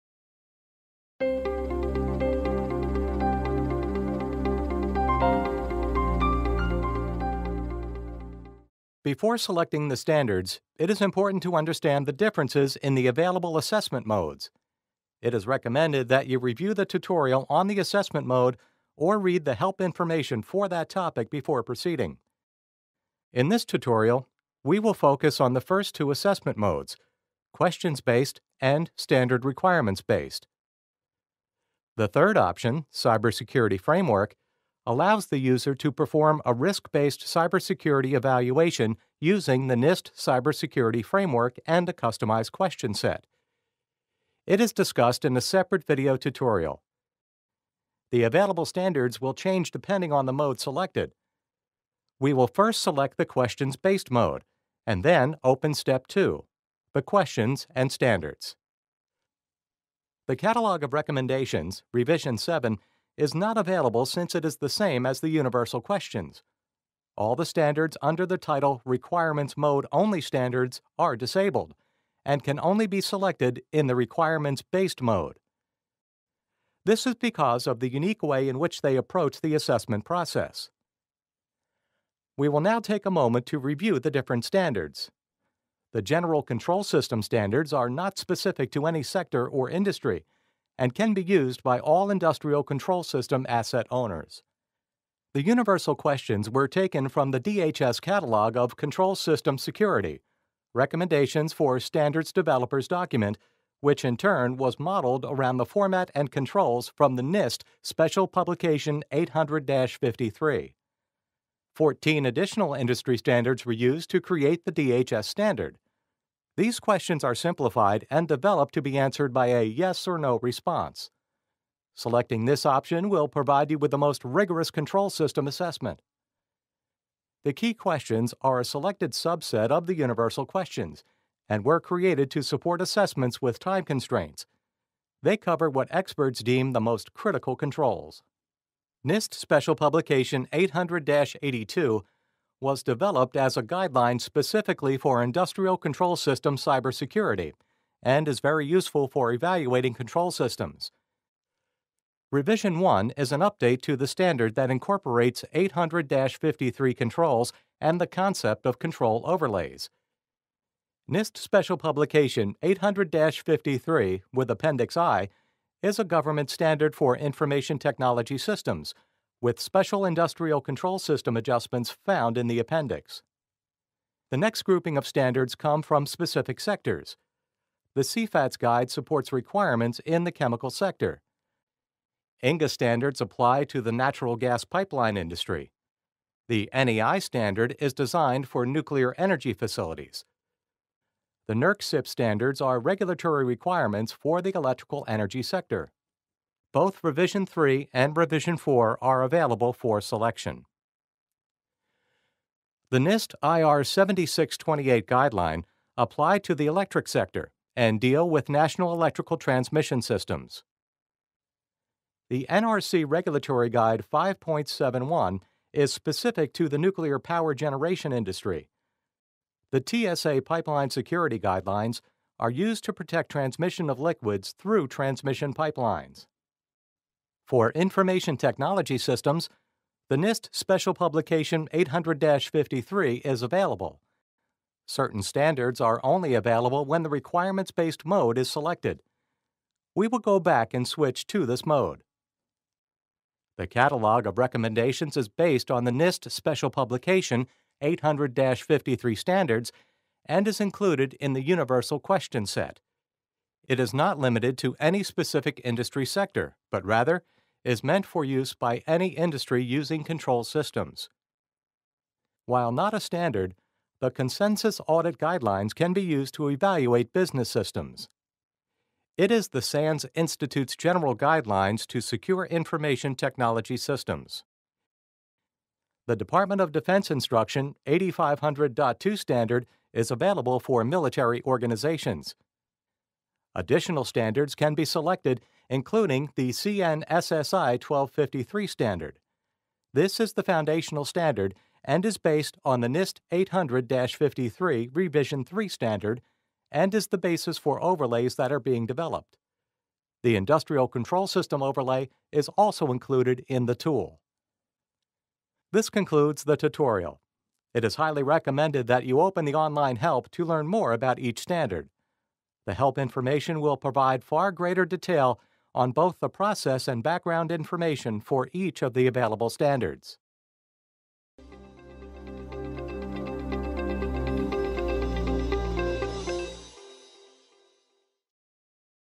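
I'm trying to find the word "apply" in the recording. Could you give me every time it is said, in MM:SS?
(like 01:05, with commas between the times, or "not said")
03:03, 03:25.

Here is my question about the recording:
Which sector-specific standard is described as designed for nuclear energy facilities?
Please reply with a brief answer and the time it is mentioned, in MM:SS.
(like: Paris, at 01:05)
NEI, at 03:06.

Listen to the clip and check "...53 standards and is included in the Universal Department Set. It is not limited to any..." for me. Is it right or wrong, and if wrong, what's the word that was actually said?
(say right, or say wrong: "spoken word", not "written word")
wrong: "Question", not "Department".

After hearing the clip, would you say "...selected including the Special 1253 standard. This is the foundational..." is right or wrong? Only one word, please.
wrong.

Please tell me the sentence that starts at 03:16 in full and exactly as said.
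Both Revision 3 and Revision 4 are available for selection.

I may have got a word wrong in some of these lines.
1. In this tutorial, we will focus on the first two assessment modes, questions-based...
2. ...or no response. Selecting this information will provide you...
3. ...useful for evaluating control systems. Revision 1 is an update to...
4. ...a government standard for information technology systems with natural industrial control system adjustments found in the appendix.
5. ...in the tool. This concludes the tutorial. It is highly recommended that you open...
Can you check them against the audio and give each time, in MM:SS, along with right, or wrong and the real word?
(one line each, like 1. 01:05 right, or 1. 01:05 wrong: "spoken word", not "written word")
1. 00:23 right
2. 02:00 wrong: "option", not "information"
3. 02:28 right
4. 02:45 wrong: "special", not "natural"
5. 05:03 right.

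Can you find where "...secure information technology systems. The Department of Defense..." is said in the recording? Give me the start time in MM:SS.
04:32.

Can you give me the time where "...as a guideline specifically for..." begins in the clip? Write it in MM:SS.
02:23.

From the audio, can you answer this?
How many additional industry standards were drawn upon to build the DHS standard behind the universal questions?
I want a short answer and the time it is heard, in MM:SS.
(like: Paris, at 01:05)
14, at 01:51.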